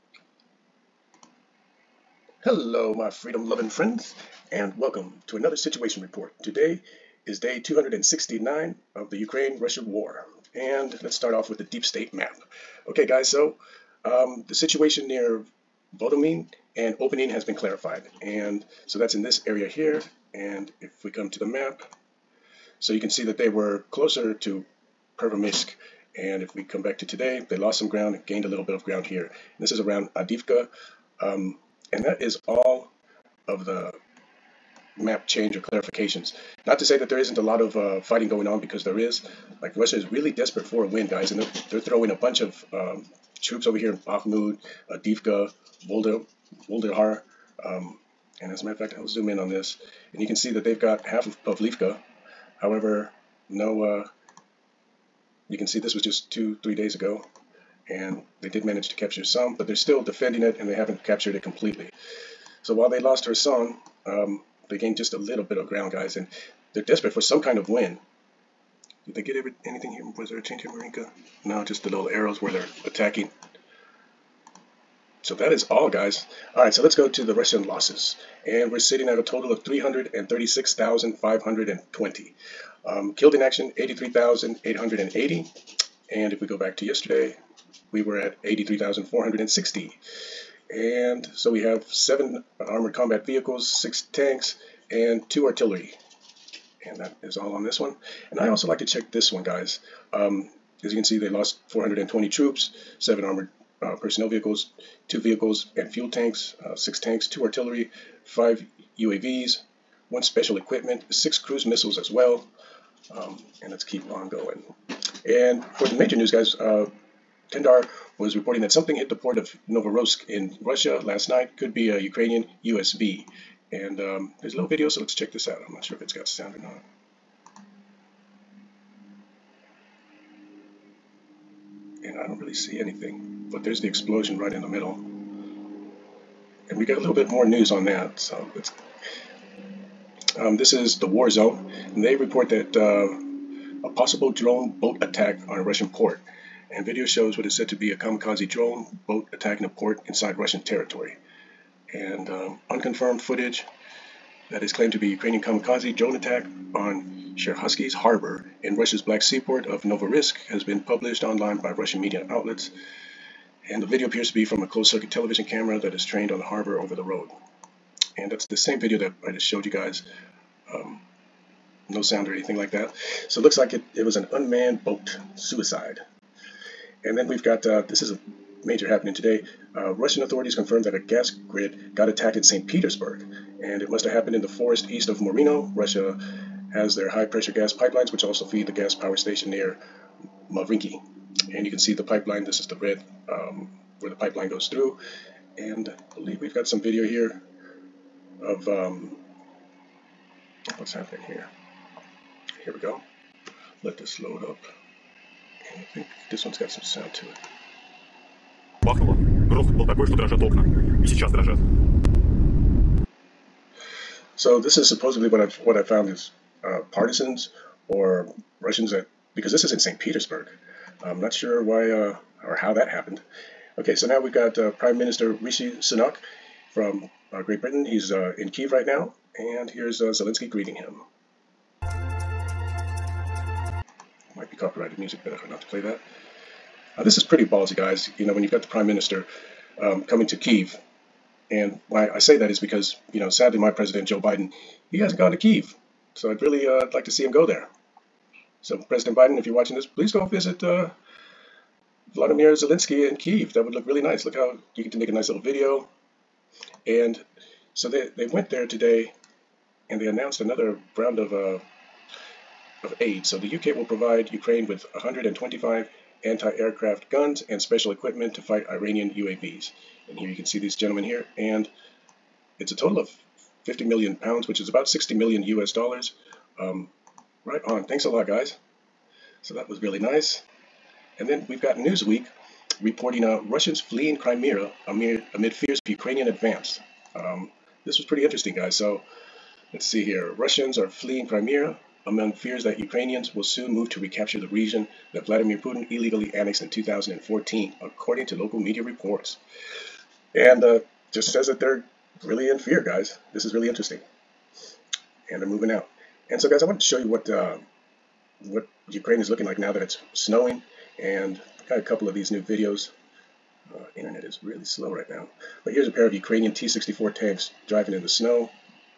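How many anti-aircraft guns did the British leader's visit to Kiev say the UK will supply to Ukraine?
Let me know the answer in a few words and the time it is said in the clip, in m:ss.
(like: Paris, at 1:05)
125, at 4:24.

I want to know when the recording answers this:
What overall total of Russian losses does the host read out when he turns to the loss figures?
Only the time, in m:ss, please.
1:19.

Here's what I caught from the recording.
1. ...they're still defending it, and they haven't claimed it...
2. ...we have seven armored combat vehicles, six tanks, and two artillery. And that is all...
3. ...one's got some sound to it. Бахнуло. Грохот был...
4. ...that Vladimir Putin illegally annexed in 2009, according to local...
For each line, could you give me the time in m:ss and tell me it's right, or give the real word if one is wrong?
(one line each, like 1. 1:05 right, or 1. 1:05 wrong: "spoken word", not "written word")
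1. 0:59 wrong: "captured", not "claimed"
2. 1:31 right
3. 3:26 right
4. 4:55 wrong: "2014", not "2009".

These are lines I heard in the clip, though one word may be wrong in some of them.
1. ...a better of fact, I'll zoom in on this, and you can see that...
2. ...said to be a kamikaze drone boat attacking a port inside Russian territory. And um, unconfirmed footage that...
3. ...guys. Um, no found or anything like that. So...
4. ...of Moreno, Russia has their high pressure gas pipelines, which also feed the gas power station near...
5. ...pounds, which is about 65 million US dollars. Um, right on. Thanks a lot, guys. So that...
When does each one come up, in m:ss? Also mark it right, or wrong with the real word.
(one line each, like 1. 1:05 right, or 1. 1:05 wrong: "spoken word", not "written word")
1. 0:48 wrong: "matter", not "better"
2. 2:27 right
3. 2:49 wrong: "sound", not "found"
4. 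3:05 right
5. 4:34 wrong: "60", not "65".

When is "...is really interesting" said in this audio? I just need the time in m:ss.
5:03.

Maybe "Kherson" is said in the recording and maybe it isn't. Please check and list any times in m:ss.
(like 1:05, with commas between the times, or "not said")
1:03.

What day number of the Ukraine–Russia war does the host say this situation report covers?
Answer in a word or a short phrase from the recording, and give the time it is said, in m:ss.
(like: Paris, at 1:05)
269, at 0:07.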